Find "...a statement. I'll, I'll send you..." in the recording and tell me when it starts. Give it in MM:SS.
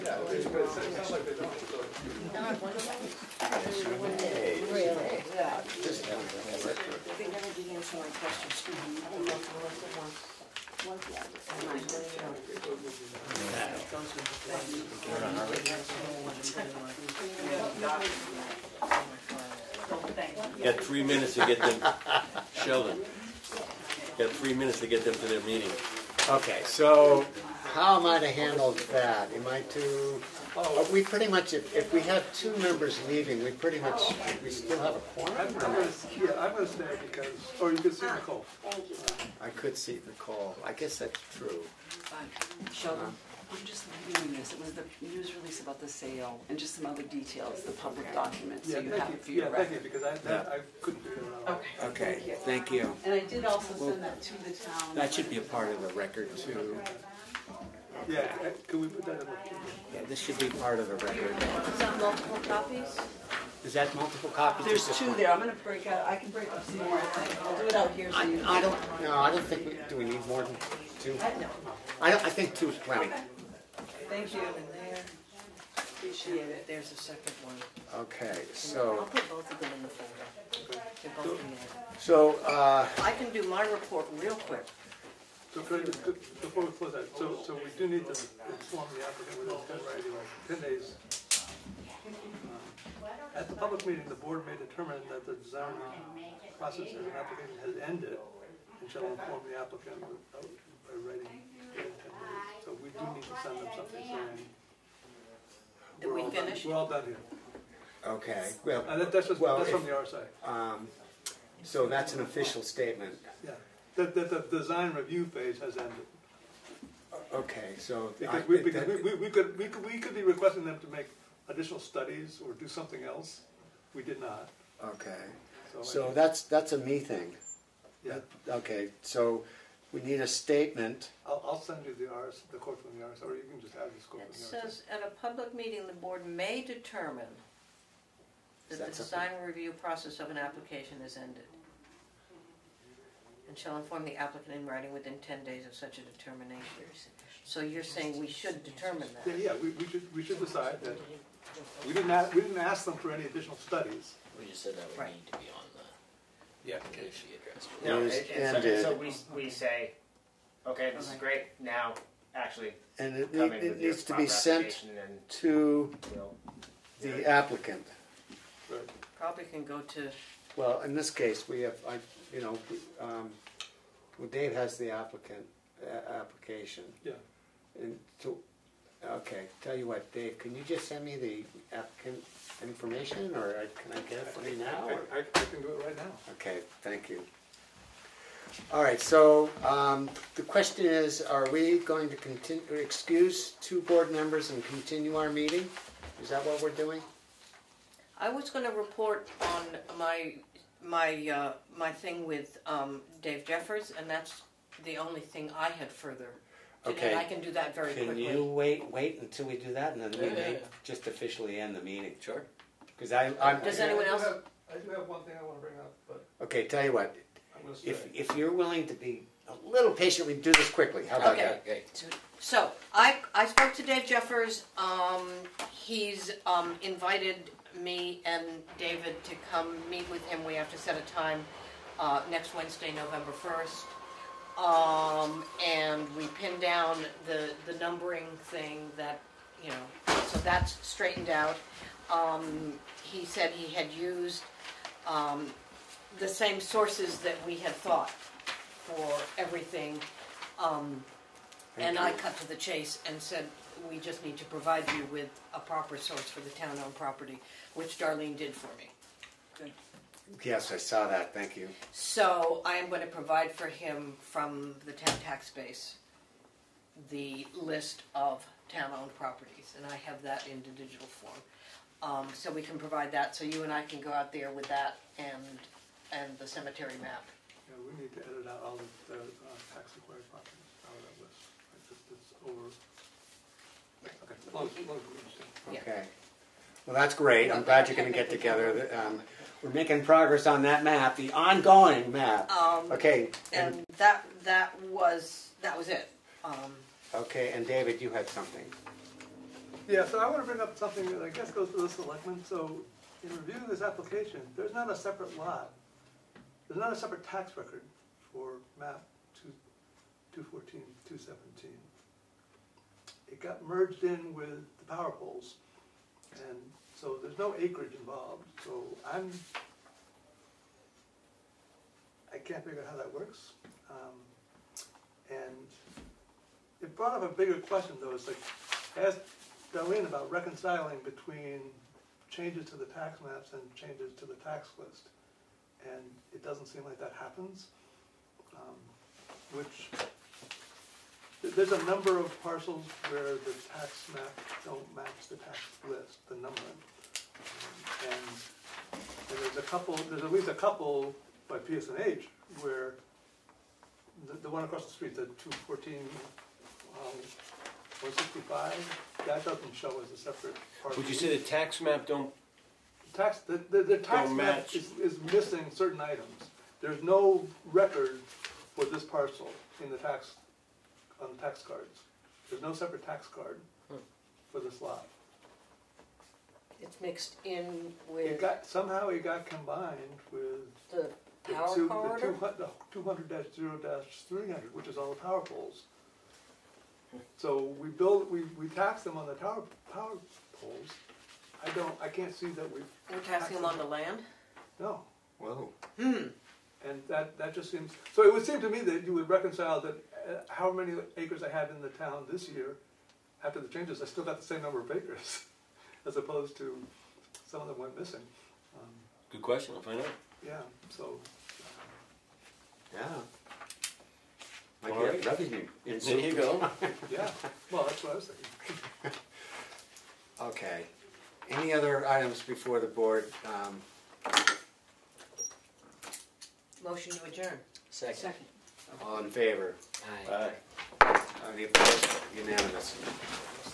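02:10.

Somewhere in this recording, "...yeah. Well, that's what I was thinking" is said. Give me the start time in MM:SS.
06:57.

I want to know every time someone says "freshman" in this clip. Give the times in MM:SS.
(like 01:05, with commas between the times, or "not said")
not said.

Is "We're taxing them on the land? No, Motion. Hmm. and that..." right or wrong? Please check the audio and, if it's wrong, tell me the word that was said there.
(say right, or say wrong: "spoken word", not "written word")
wrong: "Whoa", not "Motion".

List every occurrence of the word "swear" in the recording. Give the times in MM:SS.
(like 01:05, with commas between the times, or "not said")
not said.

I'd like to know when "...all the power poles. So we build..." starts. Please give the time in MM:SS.
06:24.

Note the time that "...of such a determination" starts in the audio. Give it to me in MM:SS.
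02:25.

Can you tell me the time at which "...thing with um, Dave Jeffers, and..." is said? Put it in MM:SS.
03:21.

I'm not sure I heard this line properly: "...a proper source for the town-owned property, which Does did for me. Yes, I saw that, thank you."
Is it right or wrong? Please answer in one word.
wrong.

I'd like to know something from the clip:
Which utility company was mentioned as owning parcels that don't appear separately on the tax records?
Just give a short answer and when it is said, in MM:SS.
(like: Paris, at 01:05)
PSNH, at 05:51.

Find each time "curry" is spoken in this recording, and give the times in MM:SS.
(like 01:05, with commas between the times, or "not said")
not said.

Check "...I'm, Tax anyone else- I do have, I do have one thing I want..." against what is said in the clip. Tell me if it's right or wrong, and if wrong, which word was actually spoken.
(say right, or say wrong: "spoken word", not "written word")
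wrong: "Does", not "Tax".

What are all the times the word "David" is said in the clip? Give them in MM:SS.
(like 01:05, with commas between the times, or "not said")
03:48, 04:57.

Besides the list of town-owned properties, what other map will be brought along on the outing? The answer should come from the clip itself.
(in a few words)
cemetery map.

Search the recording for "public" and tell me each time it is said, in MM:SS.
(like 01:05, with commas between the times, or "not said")
00:47, 01:33, 02:15.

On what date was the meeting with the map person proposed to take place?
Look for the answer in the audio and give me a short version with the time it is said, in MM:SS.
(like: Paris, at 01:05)
November 1st, at 03:52.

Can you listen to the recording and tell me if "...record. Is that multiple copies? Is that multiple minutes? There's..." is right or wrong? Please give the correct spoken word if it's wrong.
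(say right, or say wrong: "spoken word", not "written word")
wrong: "copies", not "minutes".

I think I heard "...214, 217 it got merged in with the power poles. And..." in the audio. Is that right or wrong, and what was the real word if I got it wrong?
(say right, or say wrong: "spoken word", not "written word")
right.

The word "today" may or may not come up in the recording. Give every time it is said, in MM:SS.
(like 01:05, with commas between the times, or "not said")
03:26.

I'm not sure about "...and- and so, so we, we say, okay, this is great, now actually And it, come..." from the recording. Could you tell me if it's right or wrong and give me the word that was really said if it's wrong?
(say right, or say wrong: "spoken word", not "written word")
right.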